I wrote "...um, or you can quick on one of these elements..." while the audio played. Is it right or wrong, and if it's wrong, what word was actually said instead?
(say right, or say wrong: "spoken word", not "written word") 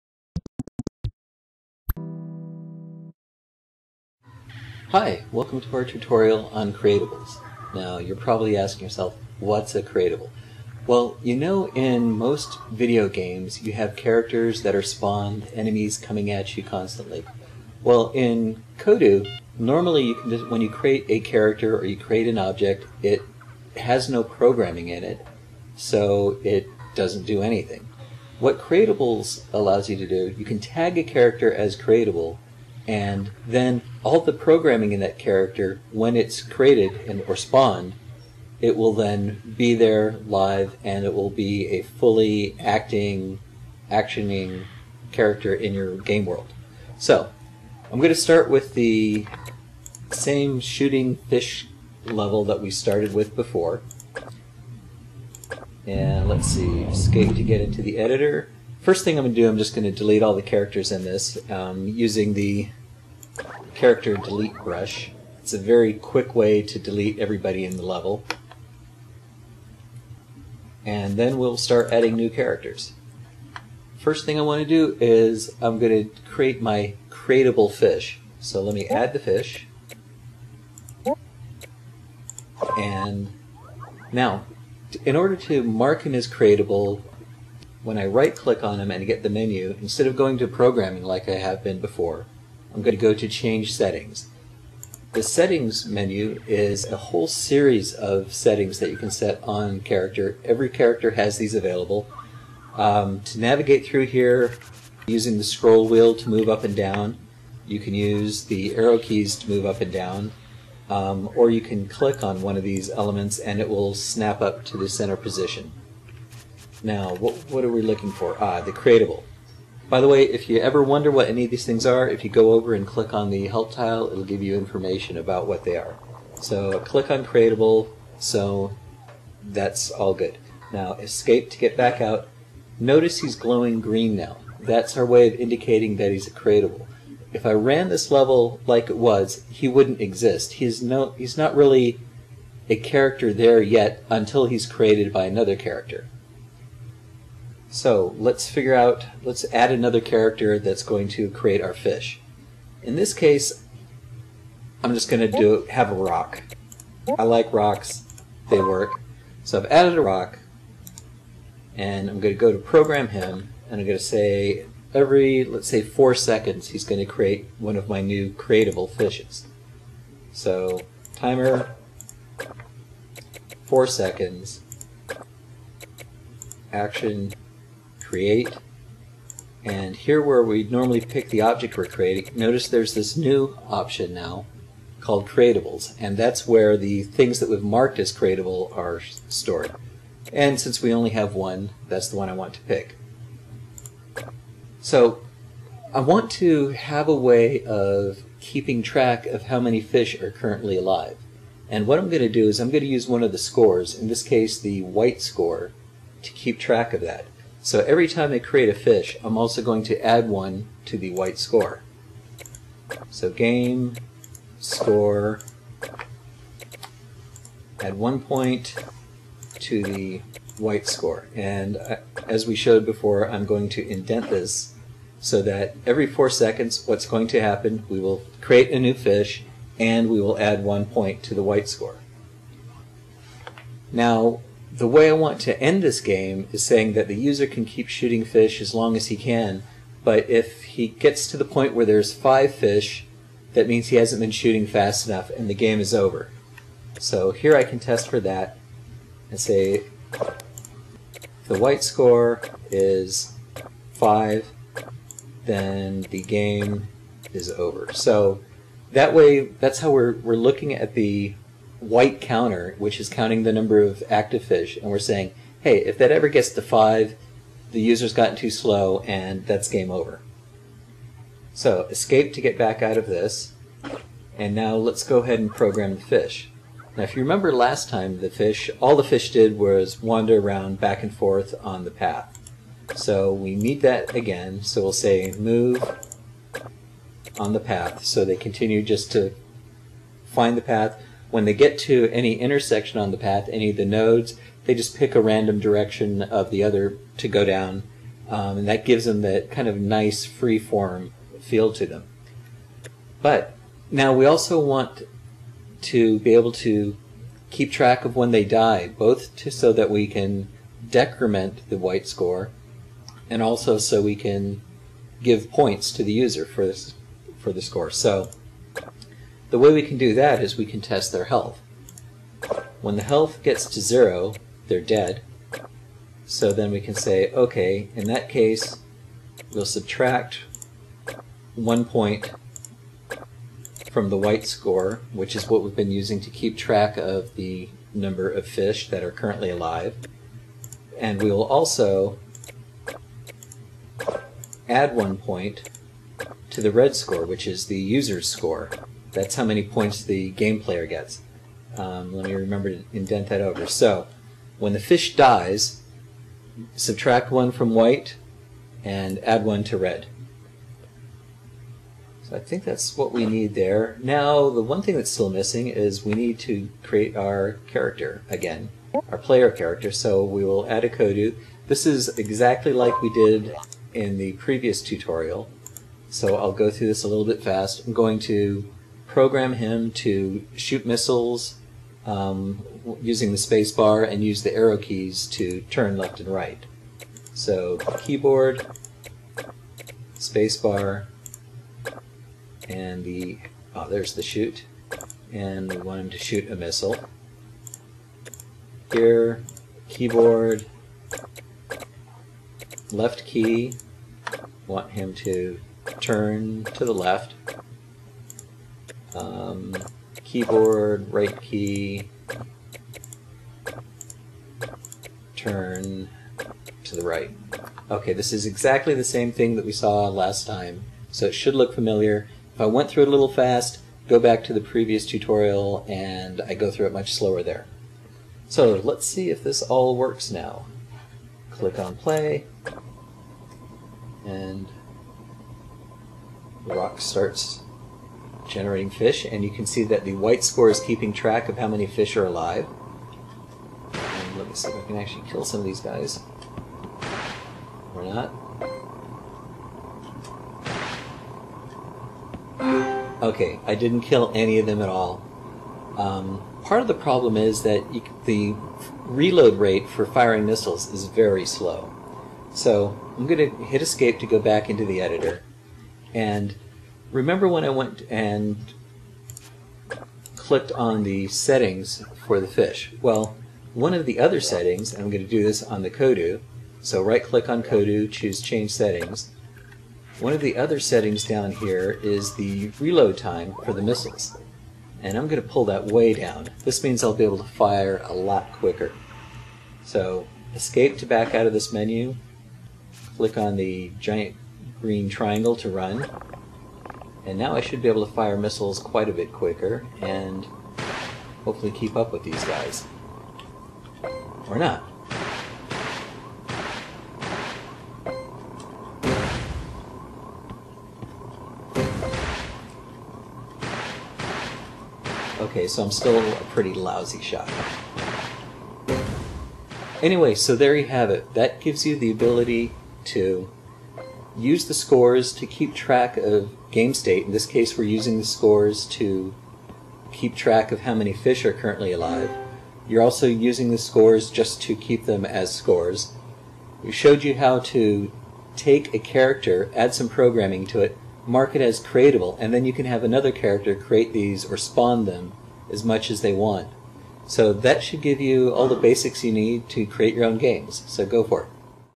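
wrong: "click", not "quick".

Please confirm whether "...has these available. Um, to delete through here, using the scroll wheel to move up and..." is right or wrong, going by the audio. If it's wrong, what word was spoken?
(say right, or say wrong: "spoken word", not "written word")
wrong: "navigate", not "delete".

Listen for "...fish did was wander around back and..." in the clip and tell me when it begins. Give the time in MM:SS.
04:39.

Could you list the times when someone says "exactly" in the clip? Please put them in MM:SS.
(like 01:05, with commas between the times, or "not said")
06:12, 06:58.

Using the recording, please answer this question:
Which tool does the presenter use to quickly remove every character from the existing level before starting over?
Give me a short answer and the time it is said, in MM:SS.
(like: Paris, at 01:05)
Character delete brush, at 01:03.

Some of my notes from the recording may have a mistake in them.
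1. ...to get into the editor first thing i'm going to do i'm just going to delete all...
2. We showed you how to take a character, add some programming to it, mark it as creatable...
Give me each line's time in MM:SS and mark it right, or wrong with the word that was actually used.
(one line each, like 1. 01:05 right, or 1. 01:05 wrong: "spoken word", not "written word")
1. 00:57 right
2. 08:56 right.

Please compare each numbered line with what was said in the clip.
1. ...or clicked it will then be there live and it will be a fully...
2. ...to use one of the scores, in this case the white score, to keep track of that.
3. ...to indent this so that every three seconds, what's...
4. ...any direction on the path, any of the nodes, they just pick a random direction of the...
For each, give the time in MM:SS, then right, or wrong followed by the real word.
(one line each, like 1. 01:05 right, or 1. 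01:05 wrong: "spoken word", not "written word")
1. 00:37 wrong: "spawned", not "clicked"
2. 03:22 right
3. 03:43 wrong: "four", not "three"
4. 04:52 wrong: "intersection", not "direction".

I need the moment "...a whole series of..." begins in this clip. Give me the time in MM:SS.
01:36.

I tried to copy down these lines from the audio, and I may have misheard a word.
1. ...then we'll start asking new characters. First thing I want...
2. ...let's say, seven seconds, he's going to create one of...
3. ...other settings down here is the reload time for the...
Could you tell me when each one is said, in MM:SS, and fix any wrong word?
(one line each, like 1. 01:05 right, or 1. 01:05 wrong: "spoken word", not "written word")
1. 01:11 wrong: "adding", not "asking"
2. 02:45 wrong: "four", not "seven"
3. 08:00 right.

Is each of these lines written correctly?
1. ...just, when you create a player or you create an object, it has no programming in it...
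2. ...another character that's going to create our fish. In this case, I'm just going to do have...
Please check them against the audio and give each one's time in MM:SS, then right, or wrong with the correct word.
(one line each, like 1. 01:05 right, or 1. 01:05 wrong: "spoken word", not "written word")
1. 00:20 wrong: "character", not "player"
2. 02:29 right.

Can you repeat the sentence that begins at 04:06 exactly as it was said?
So here I can test for that and say the white score is 5, then the game is over.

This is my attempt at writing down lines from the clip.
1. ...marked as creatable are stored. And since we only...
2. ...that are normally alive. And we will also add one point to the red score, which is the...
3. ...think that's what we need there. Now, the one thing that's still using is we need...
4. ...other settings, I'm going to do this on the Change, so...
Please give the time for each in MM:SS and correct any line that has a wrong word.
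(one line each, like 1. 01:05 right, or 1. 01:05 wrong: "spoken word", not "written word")
1. 03:07 right
2. 05:38 wrong: "currently", not "normally"
3. 06:02 wrong: "missing", not "using"
4. 07:54 wrong: "Kodu", not "Change".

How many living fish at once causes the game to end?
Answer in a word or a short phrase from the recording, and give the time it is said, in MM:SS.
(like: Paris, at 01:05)
5, at 04:02.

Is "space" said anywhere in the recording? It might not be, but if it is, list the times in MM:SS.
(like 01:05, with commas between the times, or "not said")
06:23, 06:30.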